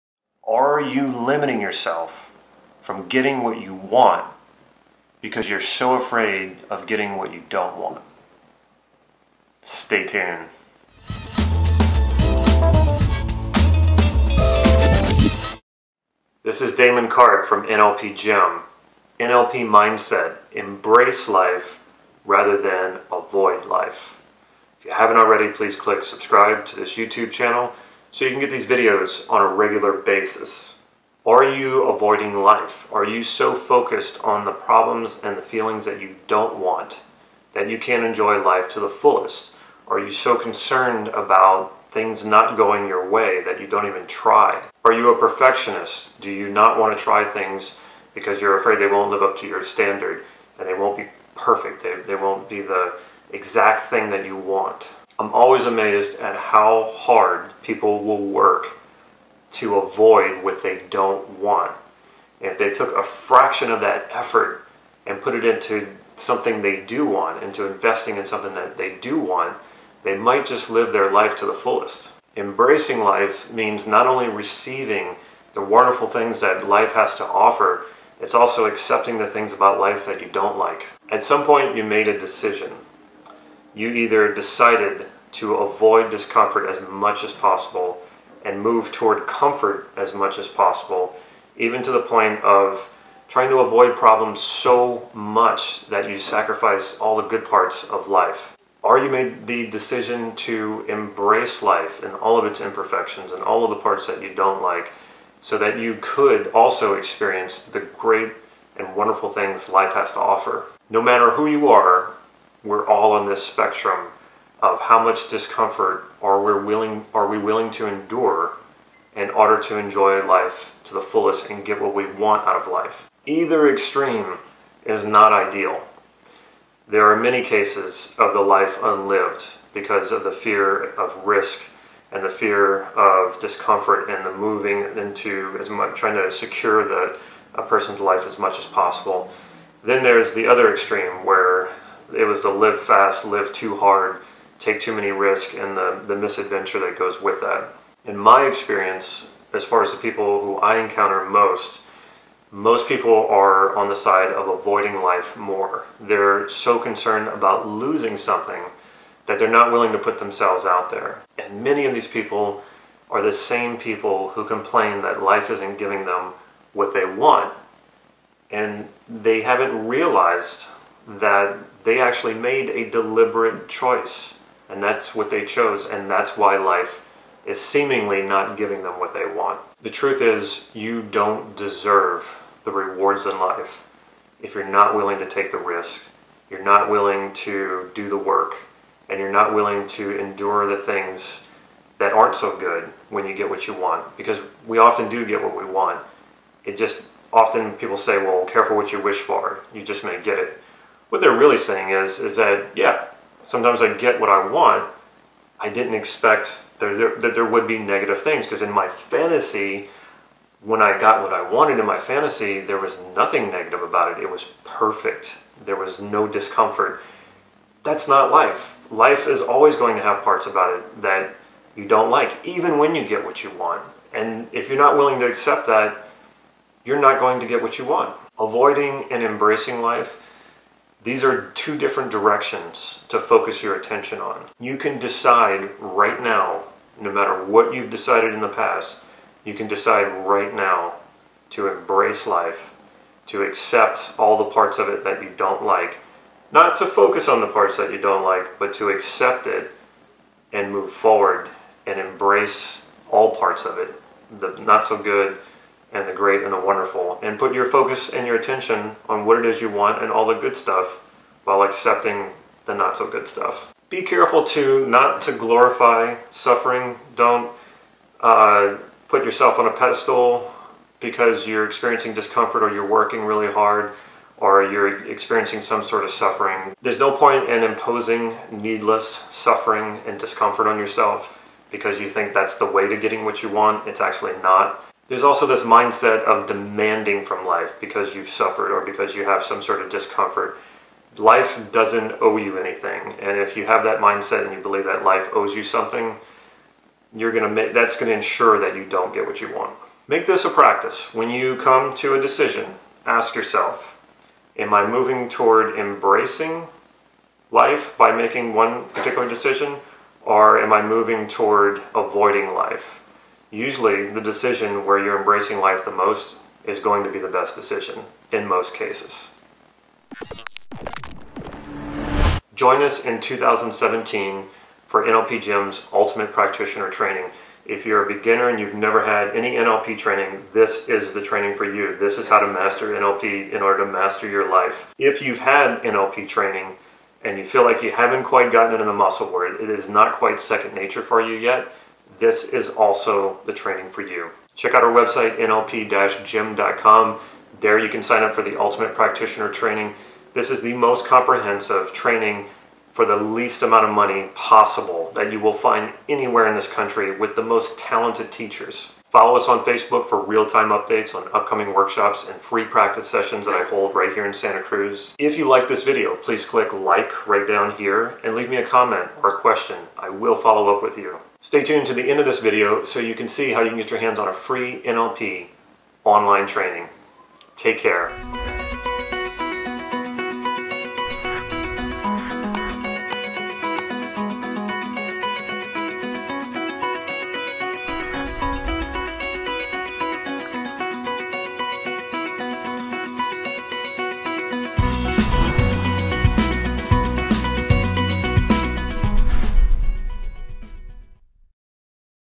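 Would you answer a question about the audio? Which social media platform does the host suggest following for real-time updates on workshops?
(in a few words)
Facebook.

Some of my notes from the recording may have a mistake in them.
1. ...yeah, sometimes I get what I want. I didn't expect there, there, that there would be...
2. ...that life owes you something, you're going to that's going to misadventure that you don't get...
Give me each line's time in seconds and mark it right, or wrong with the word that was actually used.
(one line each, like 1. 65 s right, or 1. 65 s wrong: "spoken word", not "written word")
1. 202 s right
2. 294 s wrong: "ensure", not "misadventure".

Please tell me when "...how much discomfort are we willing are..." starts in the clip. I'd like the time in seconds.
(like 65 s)
114 s.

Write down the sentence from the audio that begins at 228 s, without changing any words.
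Avoiding and embracing life these are two different directions to focus your attention on.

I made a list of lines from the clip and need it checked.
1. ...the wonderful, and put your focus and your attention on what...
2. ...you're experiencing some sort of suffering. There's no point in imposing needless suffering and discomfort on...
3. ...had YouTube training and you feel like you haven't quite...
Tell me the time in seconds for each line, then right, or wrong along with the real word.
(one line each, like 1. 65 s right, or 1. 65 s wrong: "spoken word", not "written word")
1. 256 s right
2. 274 s right
3. 335 s wrong: "NLP", not "YouTube".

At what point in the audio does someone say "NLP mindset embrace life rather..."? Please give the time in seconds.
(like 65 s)
19 s.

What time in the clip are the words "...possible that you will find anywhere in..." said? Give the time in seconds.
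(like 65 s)
354 s.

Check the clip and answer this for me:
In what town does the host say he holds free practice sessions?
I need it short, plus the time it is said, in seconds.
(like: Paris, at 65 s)
Santa Cruz, at 364 s.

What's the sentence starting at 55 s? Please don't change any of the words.
I'm always amazed at how hard people will work to avoid what they don't want.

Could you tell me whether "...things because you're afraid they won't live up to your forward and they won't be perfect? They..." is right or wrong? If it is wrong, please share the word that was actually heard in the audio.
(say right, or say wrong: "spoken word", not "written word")
wrong: "standard", not "forward".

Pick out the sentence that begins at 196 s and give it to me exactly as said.
It just often people say, well, careful what you wish for.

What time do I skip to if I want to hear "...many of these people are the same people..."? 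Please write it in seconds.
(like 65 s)
161 s.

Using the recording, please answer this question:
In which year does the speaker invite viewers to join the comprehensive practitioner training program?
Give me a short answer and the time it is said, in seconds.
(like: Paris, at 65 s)
2017, at 323 s.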